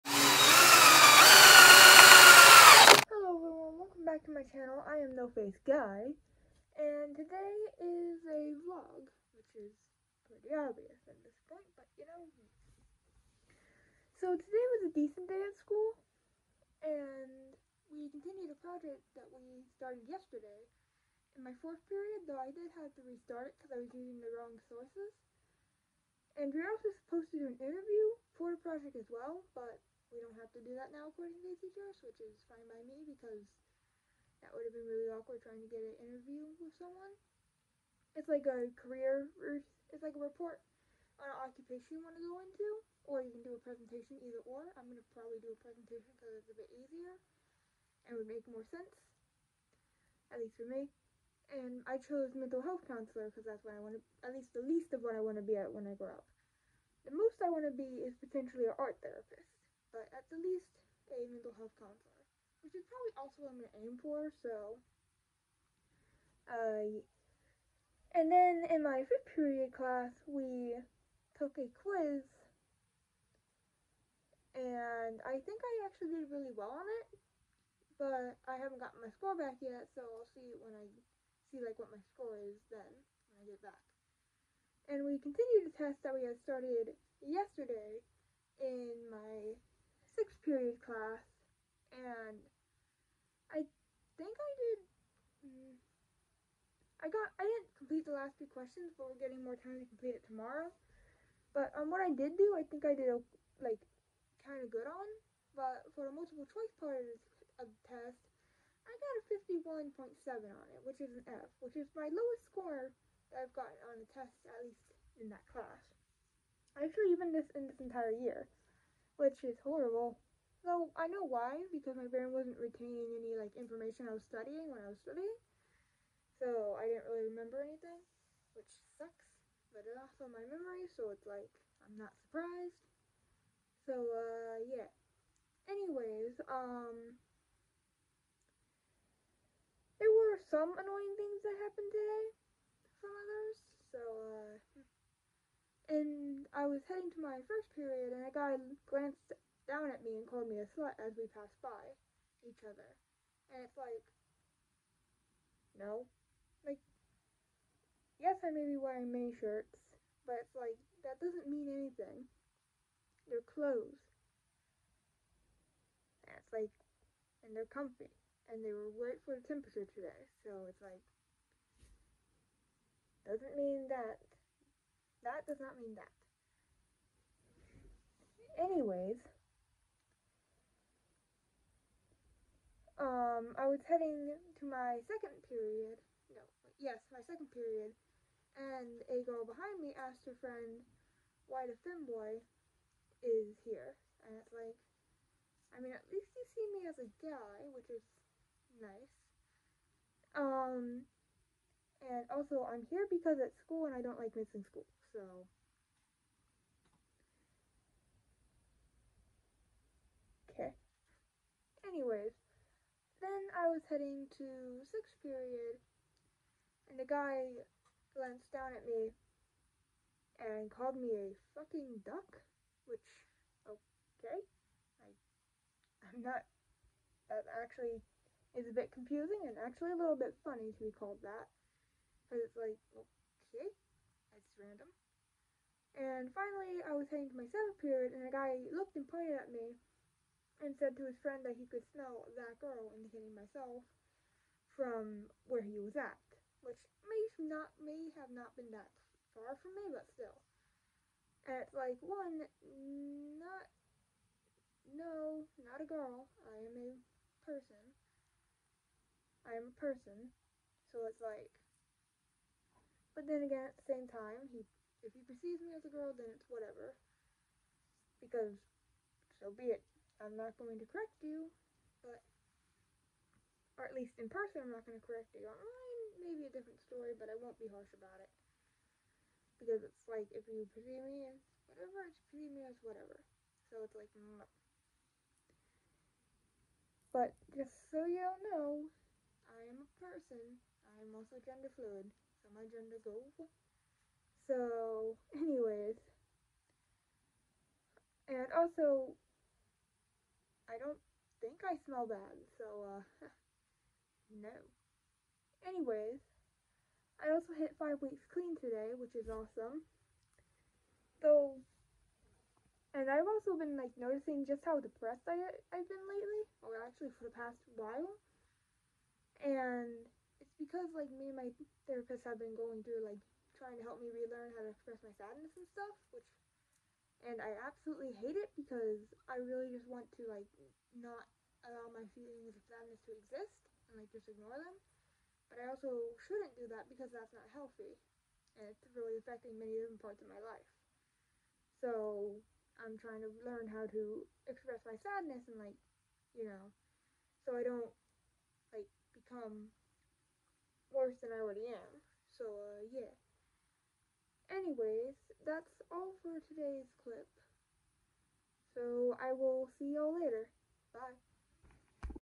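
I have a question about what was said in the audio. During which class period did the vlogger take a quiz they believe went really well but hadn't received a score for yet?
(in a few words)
5th period.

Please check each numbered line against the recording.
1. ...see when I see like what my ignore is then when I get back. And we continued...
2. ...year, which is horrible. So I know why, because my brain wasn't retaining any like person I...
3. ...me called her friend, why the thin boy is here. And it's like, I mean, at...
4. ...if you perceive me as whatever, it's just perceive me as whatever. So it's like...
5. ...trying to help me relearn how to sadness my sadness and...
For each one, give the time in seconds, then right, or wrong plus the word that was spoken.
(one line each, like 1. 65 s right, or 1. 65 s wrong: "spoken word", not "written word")
1. 80 s wrong: "score", not "ignore"
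2. 118 s wrong: "information", not "person"
3. 189 s wrong: "asked", not "called"
4. 280 s right
5. 323 s wrong: "express", not "sadness".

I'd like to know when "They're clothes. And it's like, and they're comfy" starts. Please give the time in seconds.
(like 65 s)
163 s.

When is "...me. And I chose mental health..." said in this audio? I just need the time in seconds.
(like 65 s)
50 s.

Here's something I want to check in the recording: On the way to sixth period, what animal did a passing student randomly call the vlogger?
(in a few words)
duck.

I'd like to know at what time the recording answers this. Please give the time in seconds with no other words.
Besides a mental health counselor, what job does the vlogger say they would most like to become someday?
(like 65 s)
58 s.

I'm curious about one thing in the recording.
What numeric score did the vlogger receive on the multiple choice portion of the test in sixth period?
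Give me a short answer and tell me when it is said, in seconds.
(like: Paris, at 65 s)
51.7, at 109 s.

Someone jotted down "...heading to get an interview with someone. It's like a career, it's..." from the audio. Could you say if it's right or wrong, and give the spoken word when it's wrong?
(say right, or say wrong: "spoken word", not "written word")
wrong: "trying", not "heading".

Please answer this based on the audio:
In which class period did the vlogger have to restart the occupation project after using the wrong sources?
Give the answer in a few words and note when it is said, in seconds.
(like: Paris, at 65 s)
4th period, at 21 s.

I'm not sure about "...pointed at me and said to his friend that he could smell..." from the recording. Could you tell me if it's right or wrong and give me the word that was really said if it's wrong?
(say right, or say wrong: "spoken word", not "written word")
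right.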